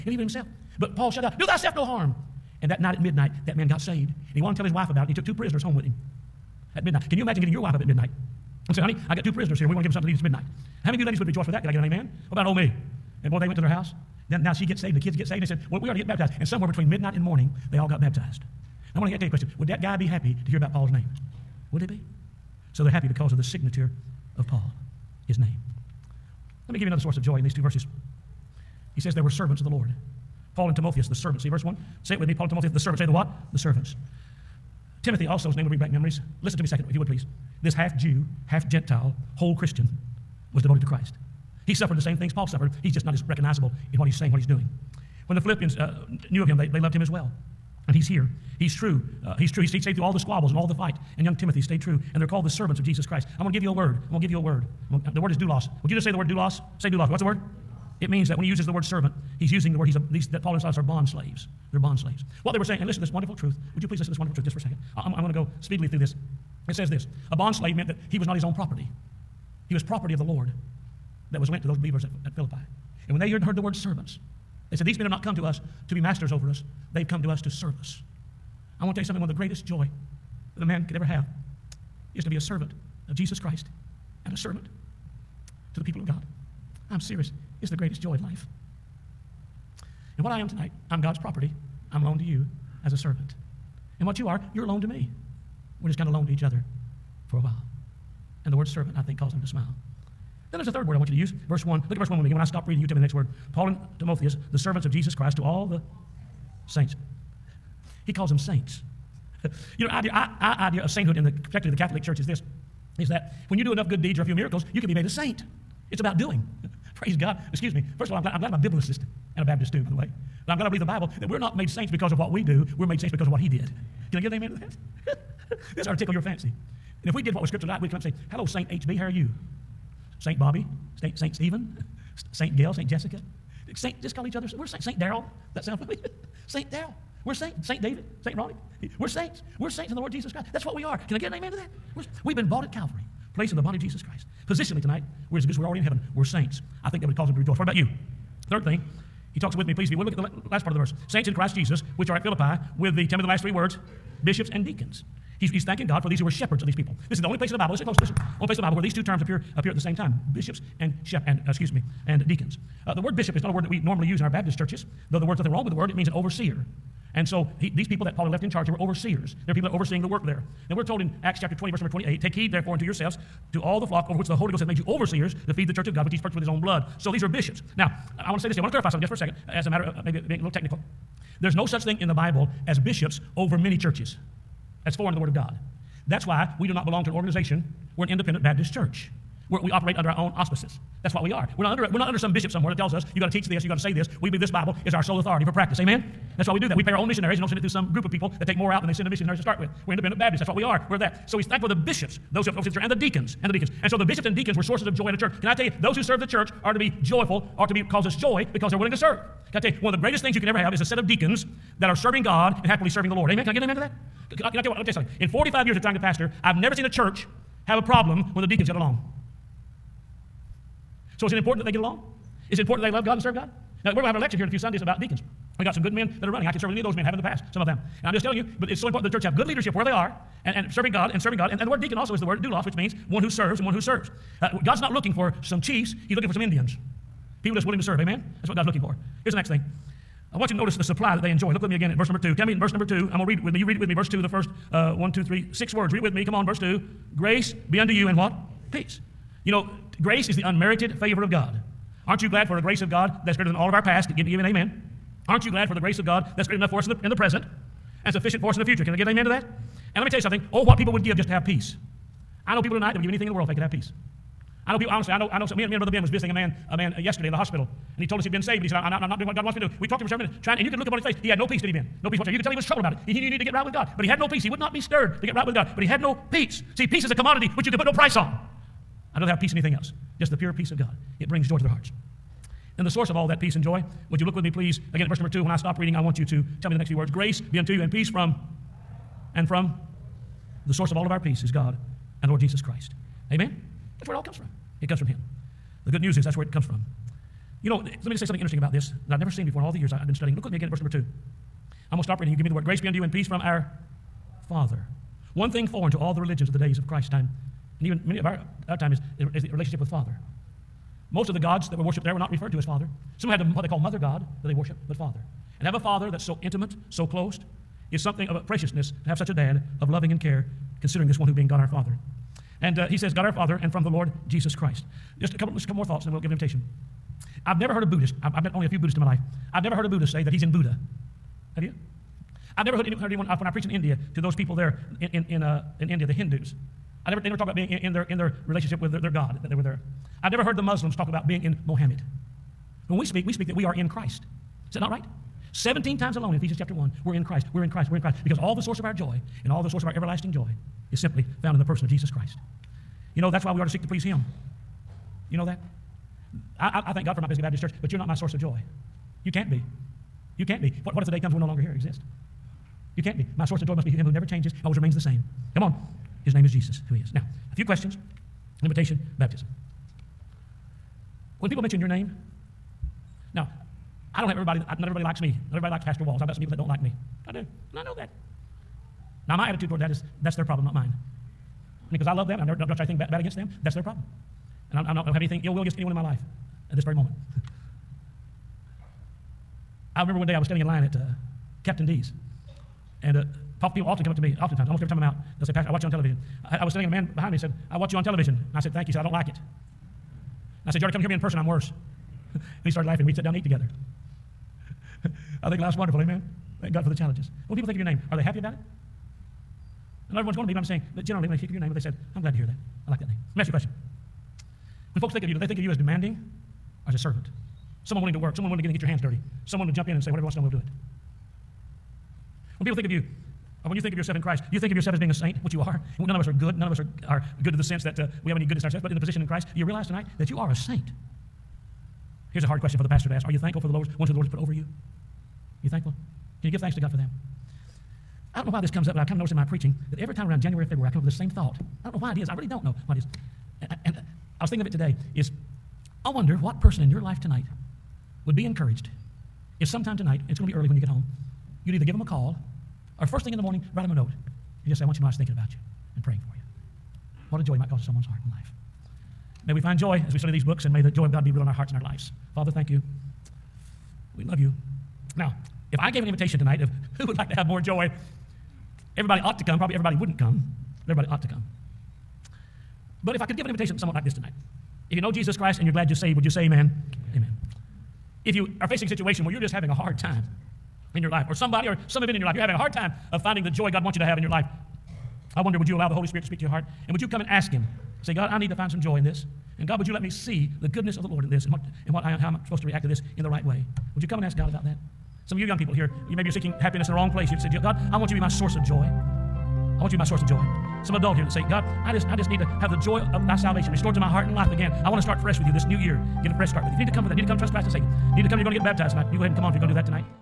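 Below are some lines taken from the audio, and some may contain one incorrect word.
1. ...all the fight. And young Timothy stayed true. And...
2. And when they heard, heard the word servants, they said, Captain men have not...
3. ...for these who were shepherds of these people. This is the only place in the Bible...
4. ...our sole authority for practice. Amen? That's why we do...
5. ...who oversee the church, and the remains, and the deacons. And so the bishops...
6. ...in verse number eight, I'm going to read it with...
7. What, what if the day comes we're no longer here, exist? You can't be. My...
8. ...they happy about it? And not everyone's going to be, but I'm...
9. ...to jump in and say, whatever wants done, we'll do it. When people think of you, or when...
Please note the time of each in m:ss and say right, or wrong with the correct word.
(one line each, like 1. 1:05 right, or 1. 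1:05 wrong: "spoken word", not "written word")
1. 0:50 right
2. 1:13 wrong: "These", not "Captain"
3. 2:36 right
4. 3:14 right
5. 3:22 wrong: "deacons", not "remains"
6. 4:02 wrong: "two", not "eight"
7. 6:00 right
8. 6:48 right
9. 6:59 right.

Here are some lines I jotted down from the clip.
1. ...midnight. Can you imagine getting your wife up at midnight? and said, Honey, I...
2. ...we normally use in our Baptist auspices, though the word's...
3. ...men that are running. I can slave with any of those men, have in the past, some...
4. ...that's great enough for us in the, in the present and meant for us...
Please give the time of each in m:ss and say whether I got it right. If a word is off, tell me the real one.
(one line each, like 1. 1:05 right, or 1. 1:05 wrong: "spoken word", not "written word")
1. 0:06 right
2. 2:43 wrong: "churches", not "auspices"
3. 3:45 wrong: "serve", not "slave"
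4. 4:16 wrong: "sufficient", not "meant".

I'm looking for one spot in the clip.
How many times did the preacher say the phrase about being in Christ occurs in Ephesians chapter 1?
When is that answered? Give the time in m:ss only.
5:45.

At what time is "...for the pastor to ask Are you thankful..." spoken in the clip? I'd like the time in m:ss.
7:12.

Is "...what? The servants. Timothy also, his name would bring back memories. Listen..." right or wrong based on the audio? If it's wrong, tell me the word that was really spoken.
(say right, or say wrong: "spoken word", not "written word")
right.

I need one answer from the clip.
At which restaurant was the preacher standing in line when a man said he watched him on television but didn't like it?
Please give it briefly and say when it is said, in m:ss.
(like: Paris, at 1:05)
Captain D's, at 6:31.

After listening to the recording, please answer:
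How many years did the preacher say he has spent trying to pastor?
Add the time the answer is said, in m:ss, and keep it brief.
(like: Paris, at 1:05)
45, at 3:35.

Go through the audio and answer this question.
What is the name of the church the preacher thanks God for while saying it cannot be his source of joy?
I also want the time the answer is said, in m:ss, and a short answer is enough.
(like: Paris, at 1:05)
Pisgah Baptist Church, at 5:57.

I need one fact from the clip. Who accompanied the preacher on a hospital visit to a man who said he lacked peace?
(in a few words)
Brother Ben.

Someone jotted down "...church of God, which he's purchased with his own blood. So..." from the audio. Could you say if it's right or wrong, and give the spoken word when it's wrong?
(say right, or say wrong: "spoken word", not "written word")
right.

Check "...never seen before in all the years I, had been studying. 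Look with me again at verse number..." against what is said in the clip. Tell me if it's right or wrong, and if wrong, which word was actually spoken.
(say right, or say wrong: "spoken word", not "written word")
right.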